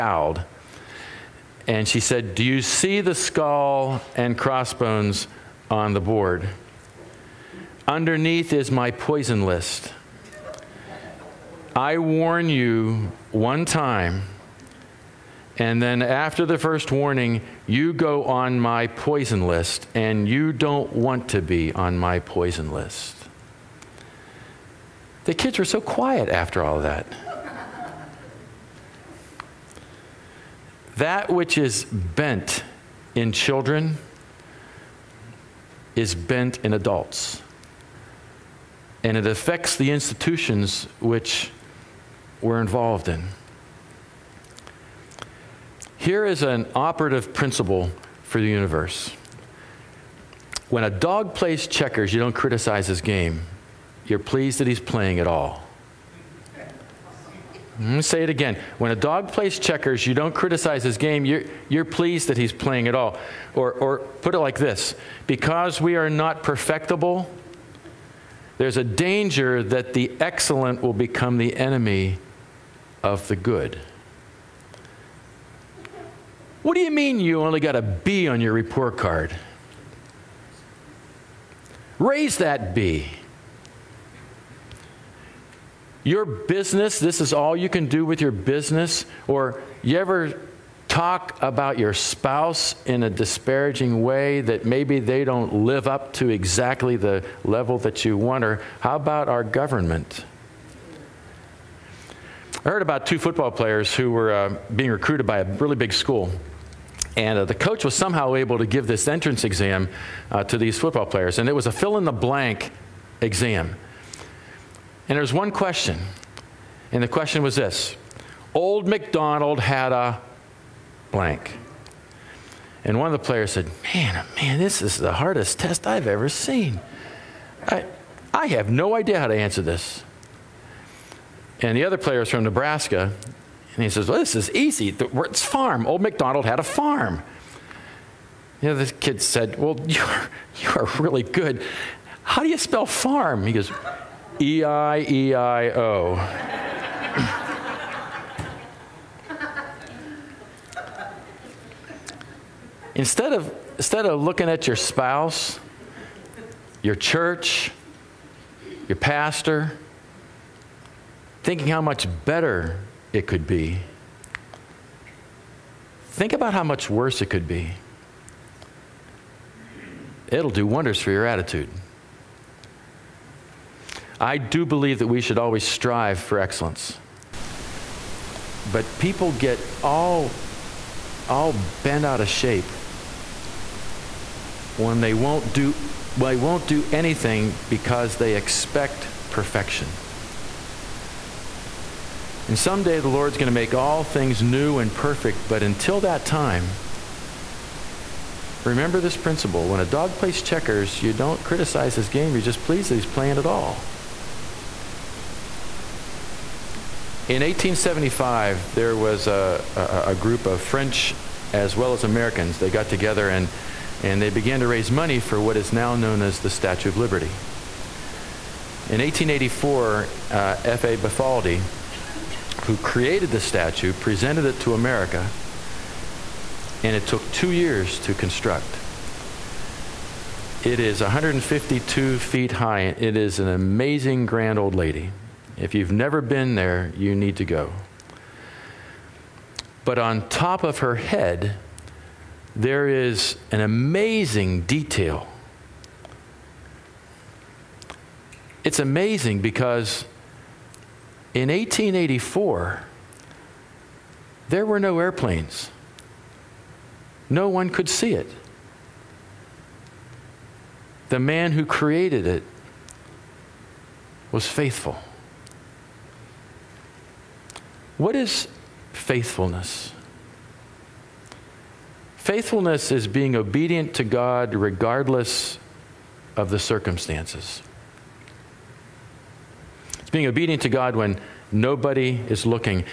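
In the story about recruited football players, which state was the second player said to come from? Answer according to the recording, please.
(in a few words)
Nebraska.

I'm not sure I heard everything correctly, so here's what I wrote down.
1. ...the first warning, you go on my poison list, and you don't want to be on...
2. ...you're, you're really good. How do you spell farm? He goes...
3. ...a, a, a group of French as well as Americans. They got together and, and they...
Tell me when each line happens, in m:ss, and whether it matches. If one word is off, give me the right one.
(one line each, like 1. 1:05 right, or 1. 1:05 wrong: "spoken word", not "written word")
1. 0:16 right
2. 2:19 right
3. 3:29 right.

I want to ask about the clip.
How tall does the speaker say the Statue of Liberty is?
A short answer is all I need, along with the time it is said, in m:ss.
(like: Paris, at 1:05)
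152 feet, at 3:50.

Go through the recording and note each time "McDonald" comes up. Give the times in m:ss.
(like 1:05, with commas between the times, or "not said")
1:58.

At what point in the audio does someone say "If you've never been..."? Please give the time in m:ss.
3:55.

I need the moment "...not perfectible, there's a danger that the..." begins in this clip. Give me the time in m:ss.
1:06.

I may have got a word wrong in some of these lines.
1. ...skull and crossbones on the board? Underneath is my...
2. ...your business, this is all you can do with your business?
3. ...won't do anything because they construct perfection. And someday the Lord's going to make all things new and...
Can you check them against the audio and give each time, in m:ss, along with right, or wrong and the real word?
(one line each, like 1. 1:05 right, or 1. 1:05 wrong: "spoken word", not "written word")
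1. 0:03 right
2. 1:26 right
3. 3:06 wrong: "expect", not "construct".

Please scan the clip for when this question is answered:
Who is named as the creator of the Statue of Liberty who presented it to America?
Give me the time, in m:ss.
3:40.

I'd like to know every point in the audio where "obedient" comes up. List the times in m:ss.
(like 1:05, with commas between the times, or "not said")
4:33, 4:40.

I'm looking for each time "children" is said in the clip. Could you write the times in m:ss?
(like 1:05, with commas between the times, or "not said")
0:33.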